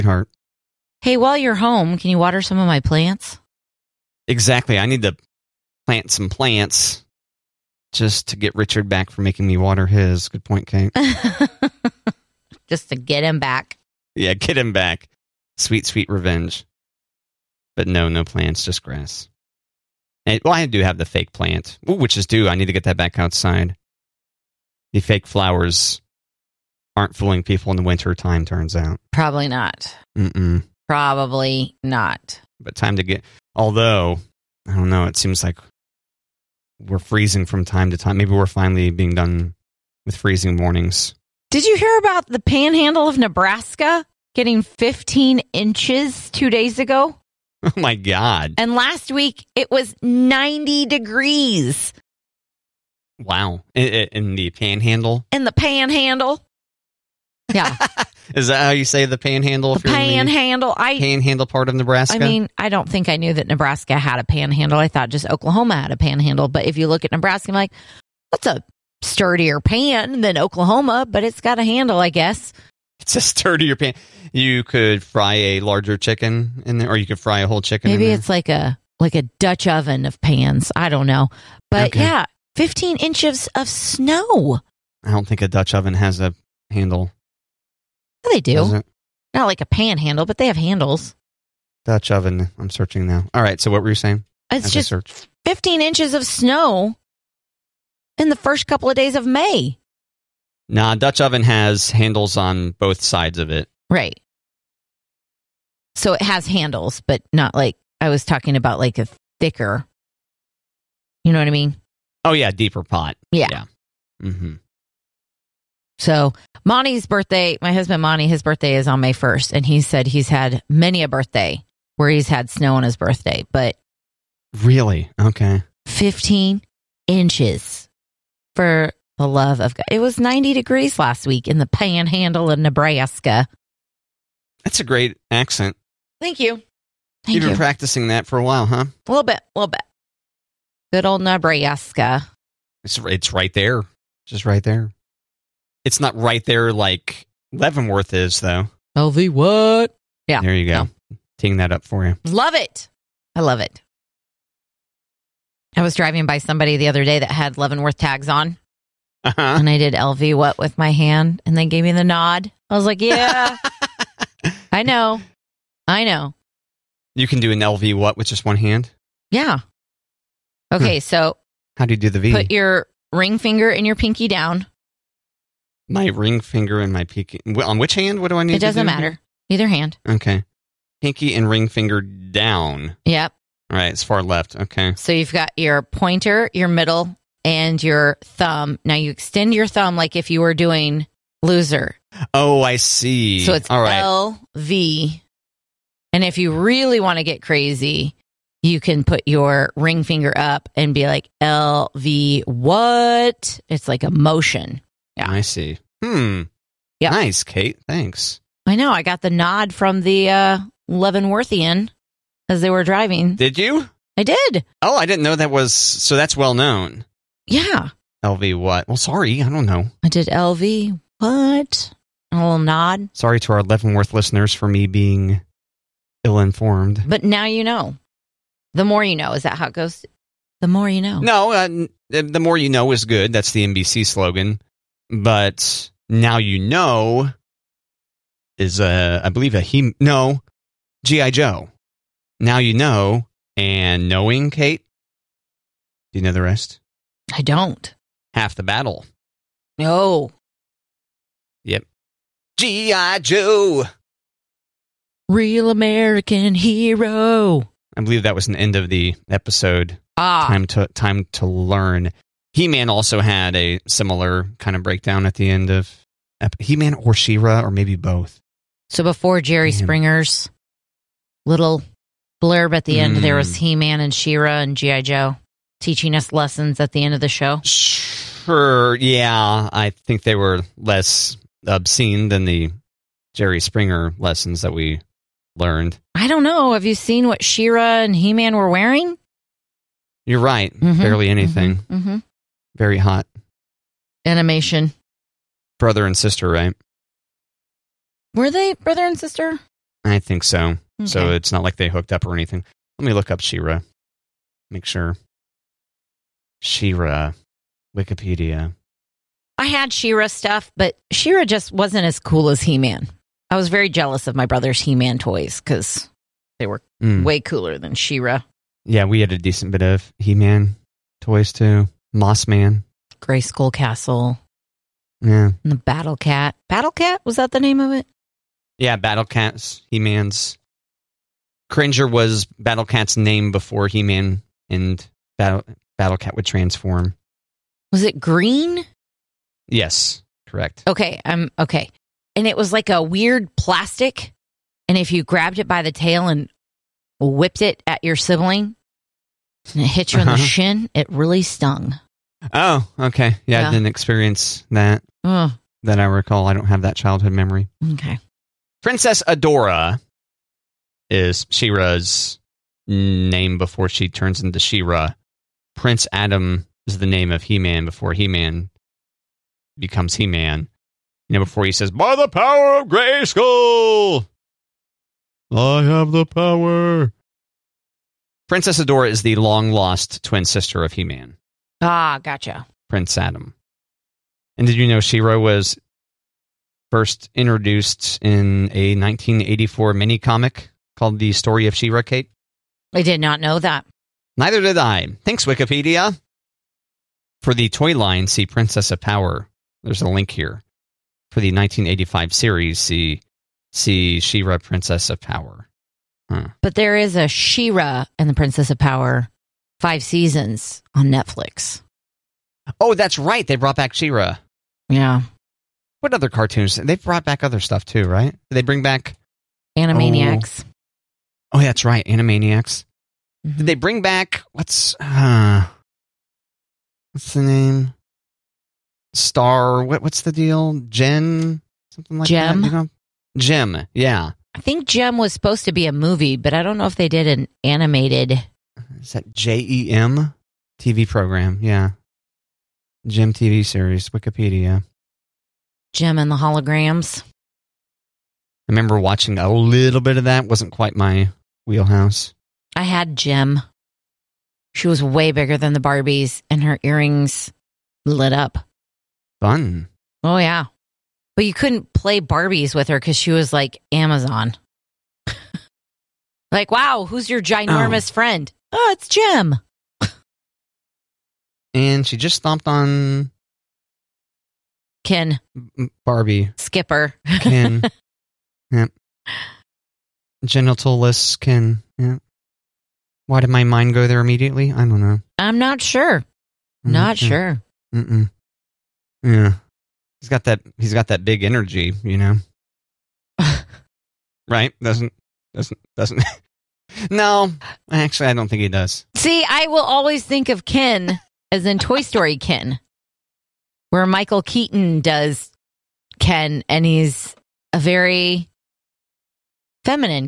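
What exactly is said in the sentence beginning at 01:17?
Maybe it's like a like a Dutch oven of pans.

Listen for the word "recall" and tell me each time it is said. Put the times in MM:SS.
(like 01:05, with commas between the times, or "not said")
05:56.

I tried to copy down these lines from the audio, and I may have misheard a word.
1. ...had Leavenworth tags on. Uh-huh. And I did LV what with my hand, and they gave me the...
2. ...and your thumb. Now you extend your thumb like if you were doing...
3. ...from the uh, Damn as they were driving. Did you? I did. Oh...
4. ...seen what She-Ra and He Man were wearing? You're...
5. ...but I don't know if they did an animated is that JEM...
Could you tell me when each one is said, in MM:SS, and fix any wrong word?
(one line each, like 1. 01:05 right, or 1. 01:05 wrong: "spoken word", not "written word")
1. 02:37 right
2. 03:07 right
3. 03:29 wrong: "Leavenworthian", not "Damn"
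4. 04:46 right
5. 07:16 right.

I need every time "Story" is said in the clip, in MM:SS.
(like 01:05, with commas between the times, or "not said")
06:31, 08:22.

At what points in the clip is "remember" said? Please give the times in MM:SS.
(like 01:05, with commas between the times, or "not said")
07:28.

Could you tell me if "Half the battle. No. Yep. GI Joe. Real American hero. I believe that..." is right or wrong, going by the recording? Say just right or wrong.
right.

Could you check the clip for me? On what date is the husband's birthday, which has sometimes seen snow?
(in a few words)
May 1st.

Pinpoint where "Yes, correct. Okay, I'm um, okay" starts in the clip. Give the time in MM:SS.
05:39.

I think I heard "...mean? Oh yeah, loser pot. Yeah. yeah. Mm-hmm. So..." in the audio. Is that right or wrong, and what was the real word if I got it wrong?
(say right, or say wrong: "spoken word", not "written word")
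wrong: "deeper", not "loser".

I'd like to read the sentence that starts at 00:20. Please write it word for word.
And, well, I do have the fake plant, which is due.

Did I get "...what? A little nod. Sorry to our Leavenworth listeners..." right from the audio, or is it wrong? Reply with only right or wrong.
right.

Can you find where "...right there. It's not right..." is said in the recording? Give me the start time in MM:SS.
02:24.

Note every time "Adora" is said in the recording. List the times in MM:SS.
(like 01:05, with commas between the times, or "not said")
05:59, 06:18.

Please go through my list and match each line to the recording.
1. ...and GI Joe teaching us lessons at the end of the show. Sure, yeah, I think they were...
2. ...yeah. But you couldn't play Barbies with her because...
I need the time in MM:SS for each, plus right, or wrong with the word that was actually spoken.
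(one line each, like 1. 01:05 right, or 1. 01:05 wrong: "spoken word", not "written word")
1. 04:34 right
2. 07:40 right.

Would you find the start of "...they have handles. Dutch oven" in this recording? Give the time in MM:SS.
01:30.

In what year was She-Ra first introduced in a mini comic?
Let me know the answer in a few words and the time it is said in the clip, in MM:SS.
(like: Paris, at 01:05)
1984, at 06:28.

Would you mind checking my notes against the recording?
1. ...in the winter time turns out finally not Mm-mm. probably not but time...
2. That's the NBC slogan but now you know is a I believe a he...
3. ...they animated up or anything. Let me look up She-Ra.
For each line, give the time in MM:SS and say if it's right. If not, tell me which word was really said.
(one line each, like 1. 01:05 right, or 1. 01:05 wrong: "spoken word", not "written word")
1. 00:27 wrong: "probably", not "finally"
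2. 03:53 right
3. 05:01 wrong: "hooked", not "animated".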